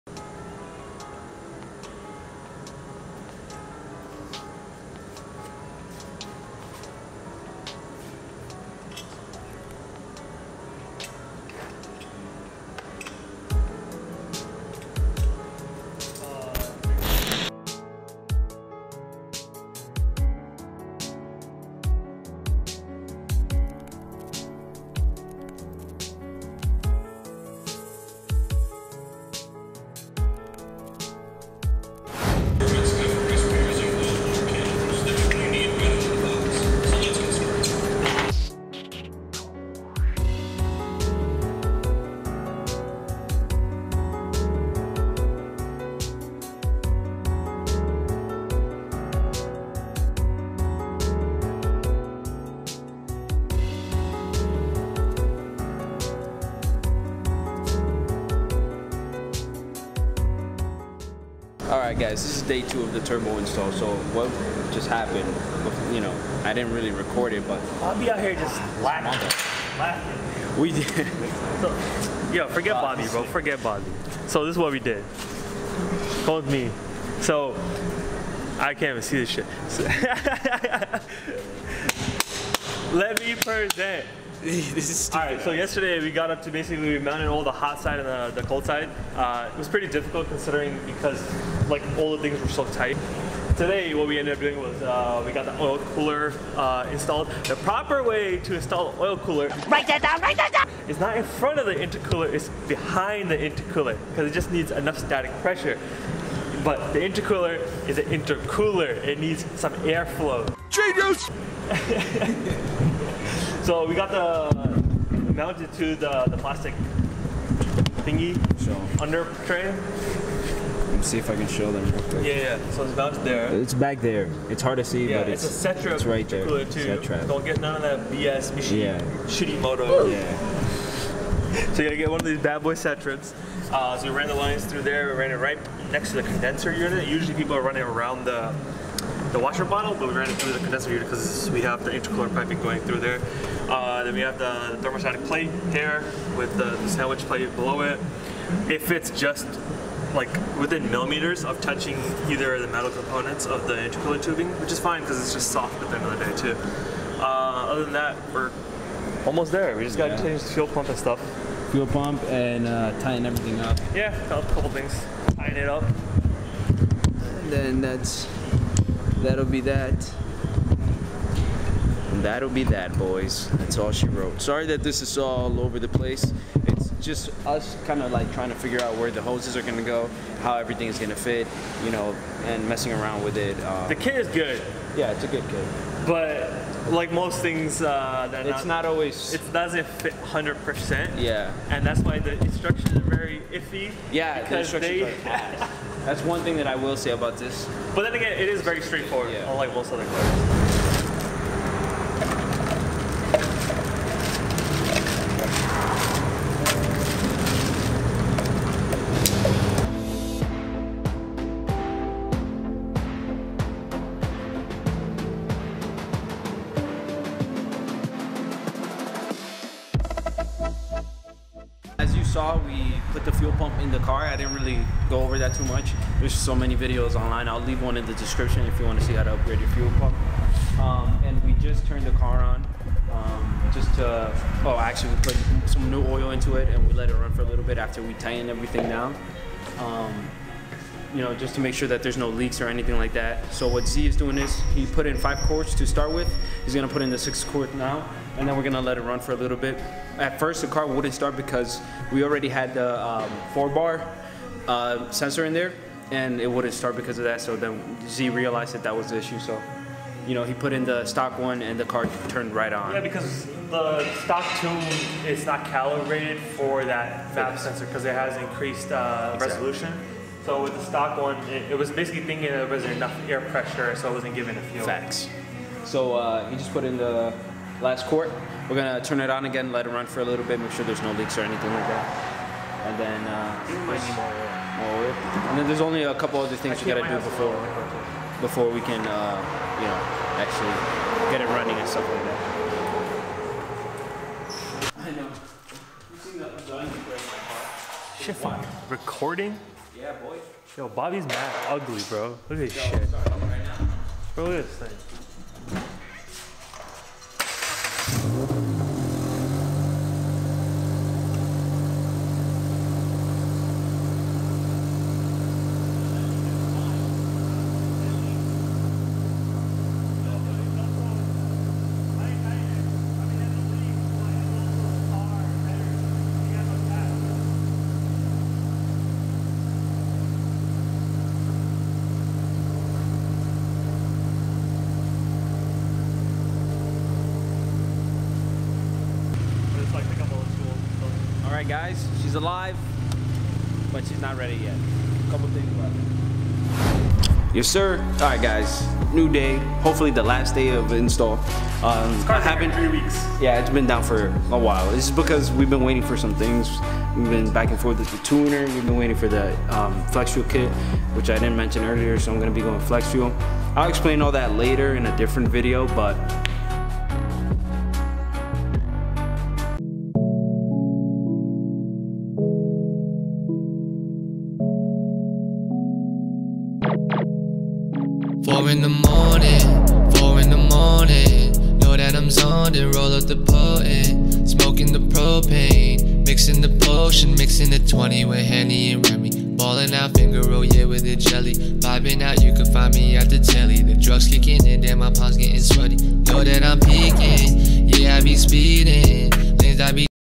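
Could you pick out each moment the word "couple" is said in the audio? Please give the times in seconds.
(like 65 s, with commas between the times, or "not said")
164 s, 286 s, 345 s.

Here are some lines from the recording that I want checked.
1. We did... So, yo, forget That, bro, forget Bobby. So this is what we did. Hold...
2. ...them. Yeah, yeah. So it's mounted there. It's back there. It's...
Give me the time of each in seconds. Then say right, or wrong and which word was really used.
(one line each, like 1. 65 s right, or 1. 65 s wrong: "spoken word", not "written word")
1. 70 s wrong: "Bobby", not "That"
2. 121 s right.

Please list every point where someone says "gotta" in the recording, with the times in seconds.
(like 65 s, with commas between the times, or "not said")
131 s, 286 s.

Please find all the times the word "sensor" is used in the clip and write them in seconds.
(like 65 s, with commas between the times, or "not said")
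255 s, 267 s.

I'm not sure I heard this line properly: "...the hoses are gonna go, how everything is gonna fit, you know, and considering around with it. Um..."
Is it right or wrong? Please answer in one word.
wrong.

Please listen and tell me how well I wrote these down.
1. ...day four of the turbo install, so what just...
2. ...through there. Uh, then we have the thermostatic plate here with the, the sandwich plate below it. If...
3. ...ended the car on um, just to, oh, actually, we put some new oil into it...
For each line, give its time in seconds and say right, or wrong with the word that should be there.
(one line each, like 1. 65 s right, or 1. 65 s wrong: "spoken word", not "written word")
1. 62 s wrong: "two", not "four"
2. 142 s right
3. 231 s wrong: "turned", not "ended".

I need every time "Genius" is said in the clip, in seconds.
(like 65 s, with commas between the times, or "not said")
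110 s.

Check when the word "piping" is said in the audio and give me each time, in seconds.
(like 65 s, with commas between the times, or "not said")
142 s.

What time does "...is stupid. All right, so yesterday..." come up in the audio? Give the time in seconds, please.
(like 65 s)
84 s.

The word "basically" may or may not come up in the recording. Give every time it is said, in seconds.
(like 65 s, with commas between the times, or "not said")
86 s, 271 s.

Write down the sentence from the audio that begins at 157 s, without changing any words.
Uh, other than that, we're almost there.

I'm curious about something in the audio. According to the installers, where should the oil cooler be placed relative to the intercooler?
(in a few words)
Behind the intercooler.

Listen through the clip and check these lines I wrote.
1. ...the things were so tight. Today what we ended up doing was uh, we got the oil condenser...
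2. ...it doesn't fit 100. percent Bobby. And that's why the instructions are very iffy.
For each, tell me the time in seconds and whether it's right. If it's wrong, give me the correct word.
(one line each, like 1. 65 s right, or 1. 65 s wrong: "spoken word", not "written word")
1. 92 s wrong: "cooler", not "condenser"
2. 189 s wrong: "Yeah", not "Bobby".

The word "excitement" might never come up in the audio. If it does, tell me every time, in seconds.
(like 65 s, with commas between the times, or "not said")
not said.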